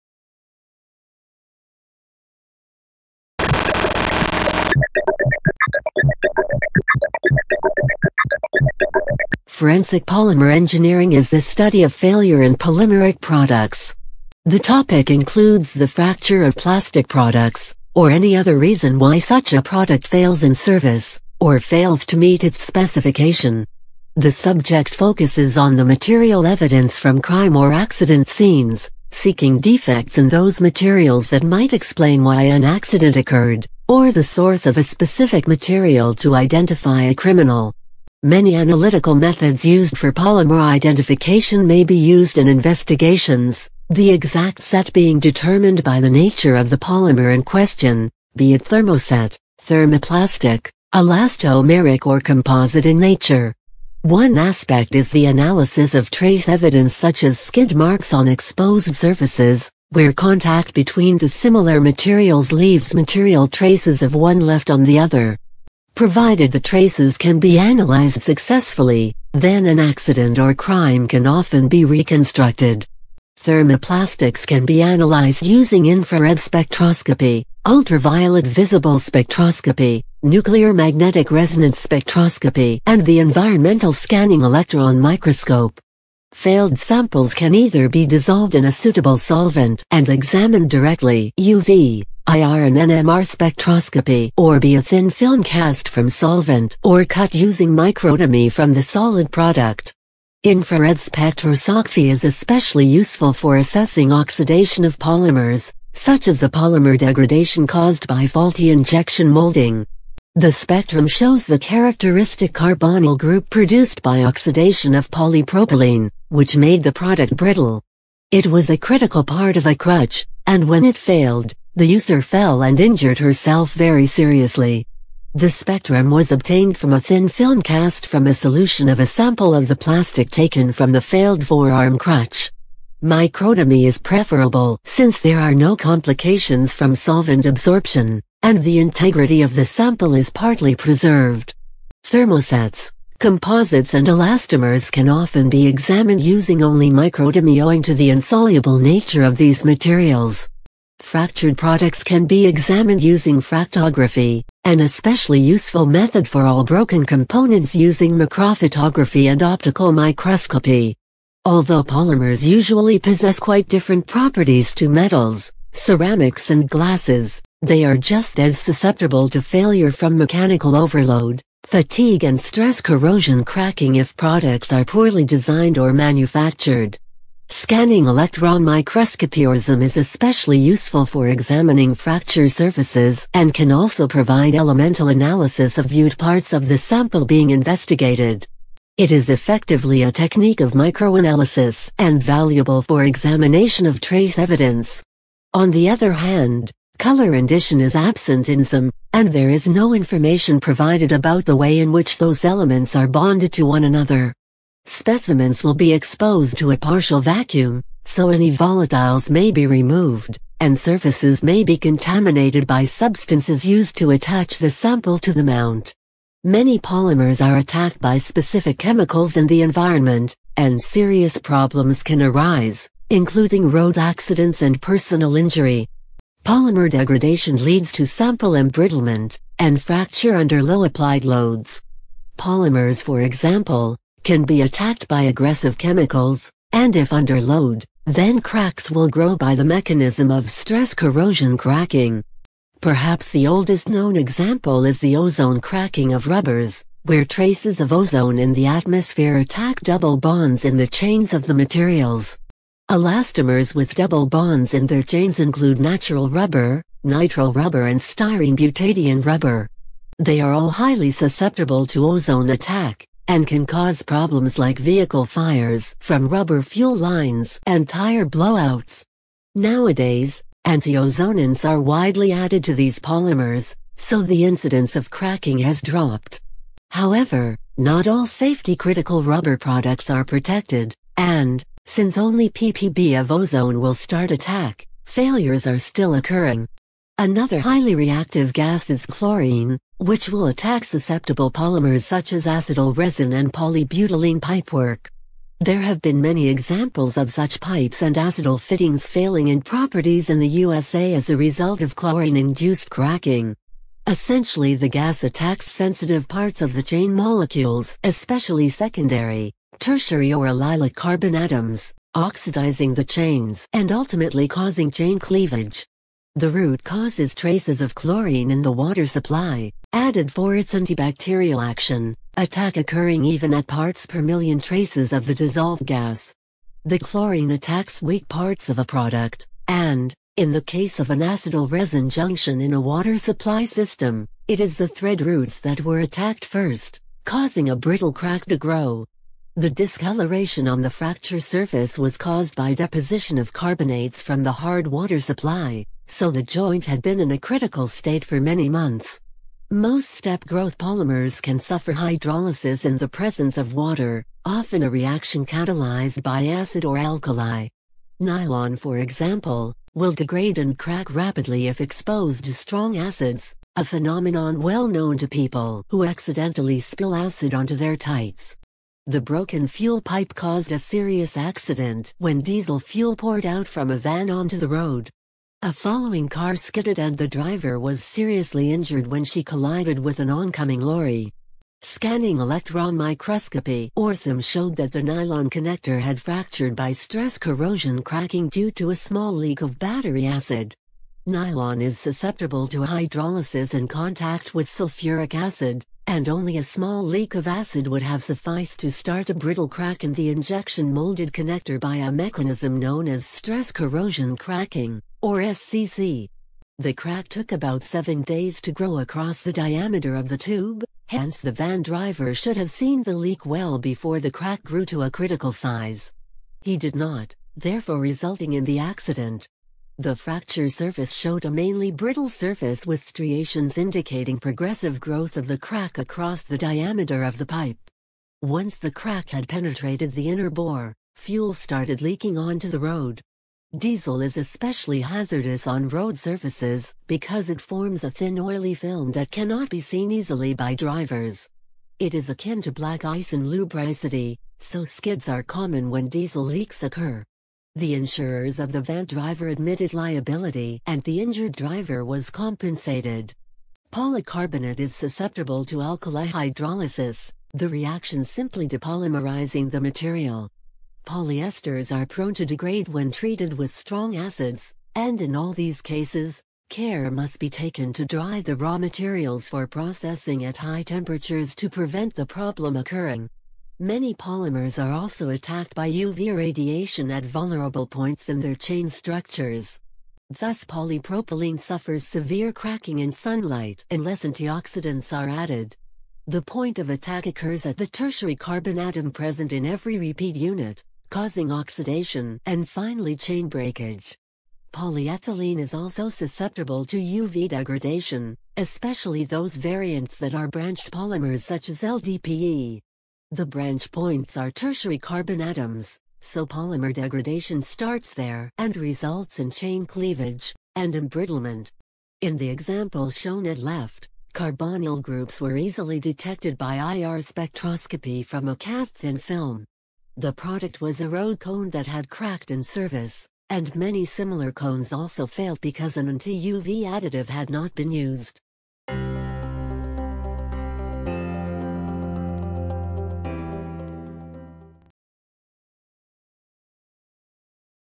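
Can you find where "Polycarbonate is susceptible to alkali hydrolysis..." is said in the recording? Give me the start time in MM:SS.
07:33.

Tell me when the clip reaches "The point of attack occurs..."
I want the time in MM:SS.
08:06.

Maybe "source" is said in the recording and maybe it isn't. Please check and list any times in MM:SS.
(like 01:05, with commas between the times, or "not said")
00:34.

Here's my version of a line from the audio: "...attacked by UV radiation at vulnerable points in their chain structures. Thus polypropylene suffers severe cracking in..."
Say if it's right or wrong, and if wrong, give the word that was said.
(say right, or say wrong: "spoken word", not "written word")
right.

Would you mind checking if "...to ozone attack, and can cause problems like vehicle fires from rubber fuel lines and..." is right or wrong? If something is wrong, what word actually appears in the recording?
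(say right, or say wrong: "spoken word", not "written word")
right.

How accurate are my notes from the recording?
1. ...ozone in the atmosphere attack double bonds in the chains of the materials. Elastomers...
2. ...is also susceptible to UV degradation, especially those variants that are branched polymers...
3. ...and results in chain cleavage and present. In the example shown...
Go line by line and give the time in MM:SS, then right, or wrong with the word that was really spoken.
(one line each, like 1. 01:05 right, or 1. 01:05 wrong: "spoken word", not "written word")
1. 04:07 right
2. 08:15 right
3. 08:28 wrong: "embrittlement", not "present".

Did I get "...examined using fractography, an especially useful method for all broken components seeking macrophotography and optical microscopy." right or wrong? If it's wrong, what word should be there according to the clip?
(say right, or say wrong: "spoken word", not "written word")
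wrong: "using", not "seeking".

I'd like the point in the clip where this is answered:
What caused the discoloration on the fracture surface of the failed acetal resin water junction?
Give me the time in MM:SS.
05:42.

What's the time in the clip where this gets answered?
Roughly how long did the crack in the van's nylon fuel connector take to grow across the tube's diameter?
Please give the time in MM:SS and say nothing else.
06:47.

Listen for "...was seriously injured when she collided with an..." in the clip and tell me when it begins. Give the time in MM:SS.
06:17.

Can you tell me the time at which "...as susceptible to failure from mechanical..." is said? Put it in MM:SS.
02:48.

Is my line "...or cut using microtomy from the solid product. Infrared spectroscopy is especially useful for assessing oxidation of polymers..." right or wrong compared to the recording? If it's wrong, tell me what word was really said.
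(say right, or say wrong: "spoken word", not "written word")
right.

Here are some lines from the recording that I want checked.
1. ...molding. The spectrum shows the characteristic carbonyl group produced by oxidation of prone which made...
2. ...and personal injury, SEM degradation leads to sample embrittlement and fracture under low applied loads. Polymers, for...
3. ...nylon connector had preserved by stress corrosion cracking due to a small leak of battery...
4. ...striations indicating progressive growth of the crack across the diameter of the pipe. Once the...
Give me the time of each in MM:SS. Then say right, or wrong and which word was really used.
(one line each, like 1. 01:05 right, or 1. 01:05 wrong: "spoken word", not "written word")
1. 01:49 wrong: "polypropylene", not "prone"
2. 03:44 wrong: "Polymer", not "SEM"
3. 06:25 wrong: "fractured", not "preserved"
4. 07:03 right.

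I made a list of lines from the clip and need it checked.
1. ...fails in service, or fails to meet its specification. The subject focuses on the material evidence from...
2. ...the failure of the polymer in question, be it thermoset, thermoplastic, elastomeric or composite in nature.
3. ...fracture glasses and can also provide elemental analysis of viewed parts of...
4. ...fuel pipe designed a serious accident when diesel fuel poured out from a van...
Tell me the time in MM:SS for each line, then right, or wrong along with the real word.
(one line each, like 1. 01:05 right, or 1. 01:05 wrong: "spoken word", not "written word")
1. 00:20 right
2. 00:45 wrong: "nature", not "failure"
3. 03:01 wrong: "surfaces", not "glasses"
4. 06:09 wrong: "caused", not "designed".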